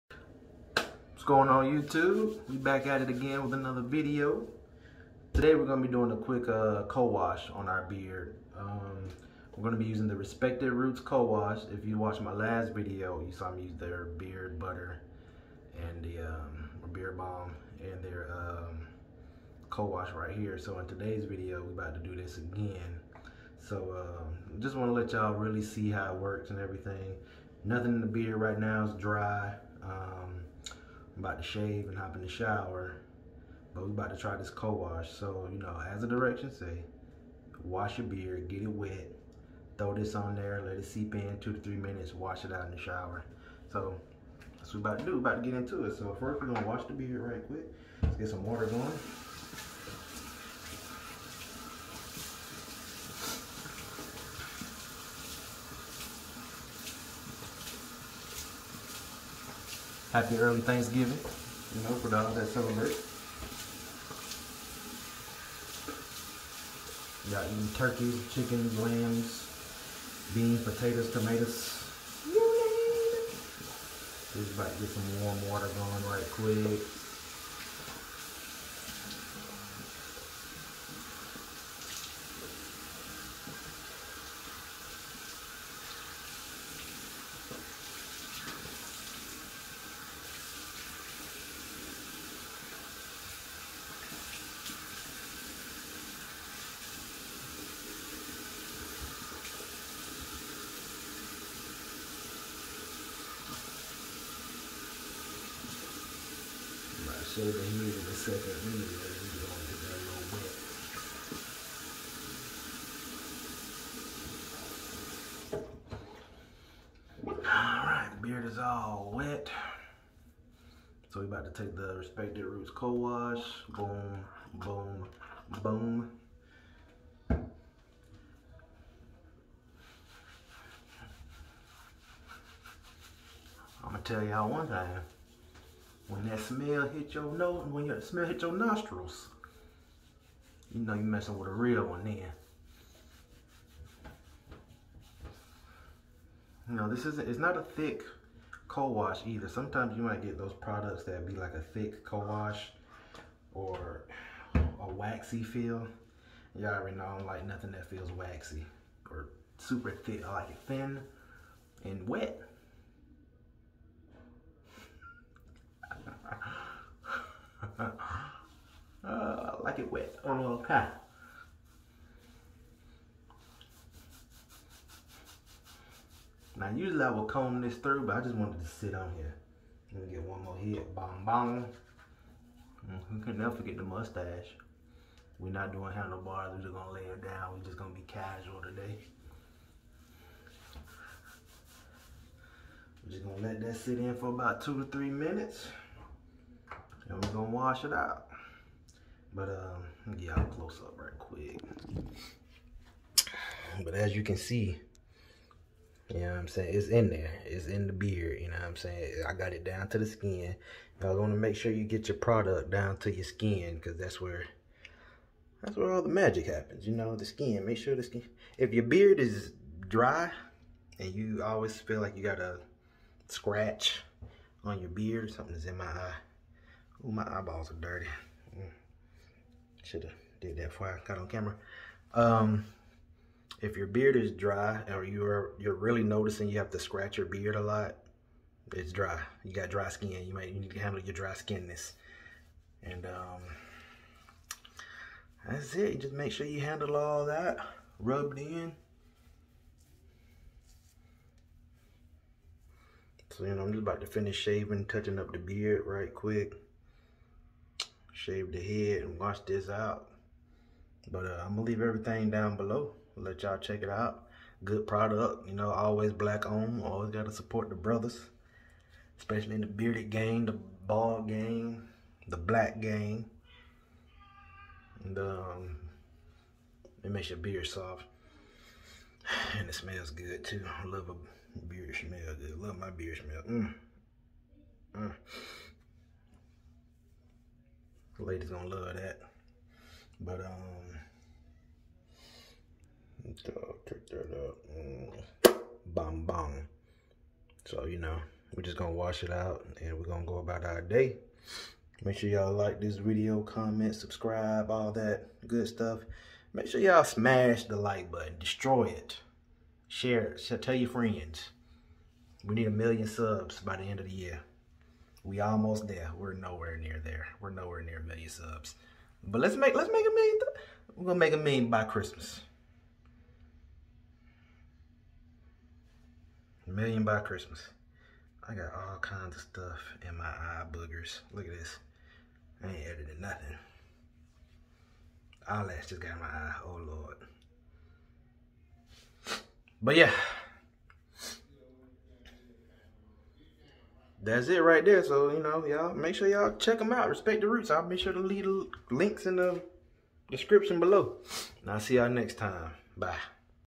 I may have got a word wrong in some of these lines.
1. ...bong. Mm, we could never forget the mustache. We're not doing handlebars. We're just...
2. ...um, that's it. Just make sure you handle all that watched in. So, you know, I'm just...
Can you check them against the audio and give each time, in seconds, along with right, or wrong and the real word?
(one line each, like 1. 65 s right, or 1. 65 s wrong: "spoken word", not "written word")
1. 181 s right
2. 243 s wrong: "rubbed", not "watched".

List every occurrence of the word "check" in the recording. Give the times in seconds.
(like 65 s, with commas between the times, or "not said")
263 s, 346 s.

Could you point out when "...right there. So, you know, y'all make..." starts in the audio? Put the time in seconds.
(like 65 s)
344 s.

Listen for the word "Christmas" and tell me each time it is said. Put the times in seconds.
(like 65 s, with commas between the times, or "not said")
321 s, 327 s.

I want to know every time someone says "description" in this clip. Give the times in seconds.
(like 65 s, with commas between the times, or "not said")
350 s.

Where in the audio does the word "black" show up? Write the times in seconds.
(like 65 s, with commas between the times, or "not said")
266 s, 272 s.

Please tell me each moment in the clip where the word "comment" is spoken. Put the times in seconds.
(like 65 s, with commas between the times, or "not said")
303 s.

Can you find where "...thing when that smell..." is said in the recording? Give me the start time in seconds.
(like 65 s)
134 s.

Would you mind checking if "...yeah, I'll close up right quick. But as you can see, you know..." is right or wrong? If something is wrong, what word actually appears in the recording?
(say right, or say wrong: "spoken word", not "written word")
right.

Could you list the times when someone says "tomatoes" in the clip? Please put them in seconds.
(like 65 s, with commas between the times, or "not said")
71 s.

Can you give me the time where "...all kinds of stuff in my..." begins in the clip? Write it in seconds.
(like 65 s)
328 s.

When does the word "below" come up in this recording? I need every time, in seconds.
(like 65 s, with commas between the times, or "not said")
262 s, 350 s.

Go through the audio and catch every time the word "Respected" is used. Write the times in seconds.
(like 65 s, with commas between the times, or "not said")
10 s, 121 s, 347 s.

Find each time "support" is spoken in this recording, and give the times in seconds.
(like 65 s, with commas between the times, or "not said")
267 s.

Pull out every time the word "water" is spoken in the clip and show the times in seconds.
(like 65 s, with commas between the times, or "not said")
48 s, 75 s.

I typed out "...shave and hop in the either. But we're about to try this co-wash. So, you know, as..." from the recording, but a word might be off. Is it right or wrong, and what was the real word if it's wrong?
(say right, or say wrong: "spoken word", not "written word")
wrong: "shower", not "either".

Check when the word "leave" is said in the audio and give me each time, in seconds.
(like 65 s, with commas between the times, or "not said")
261 s, 348 s.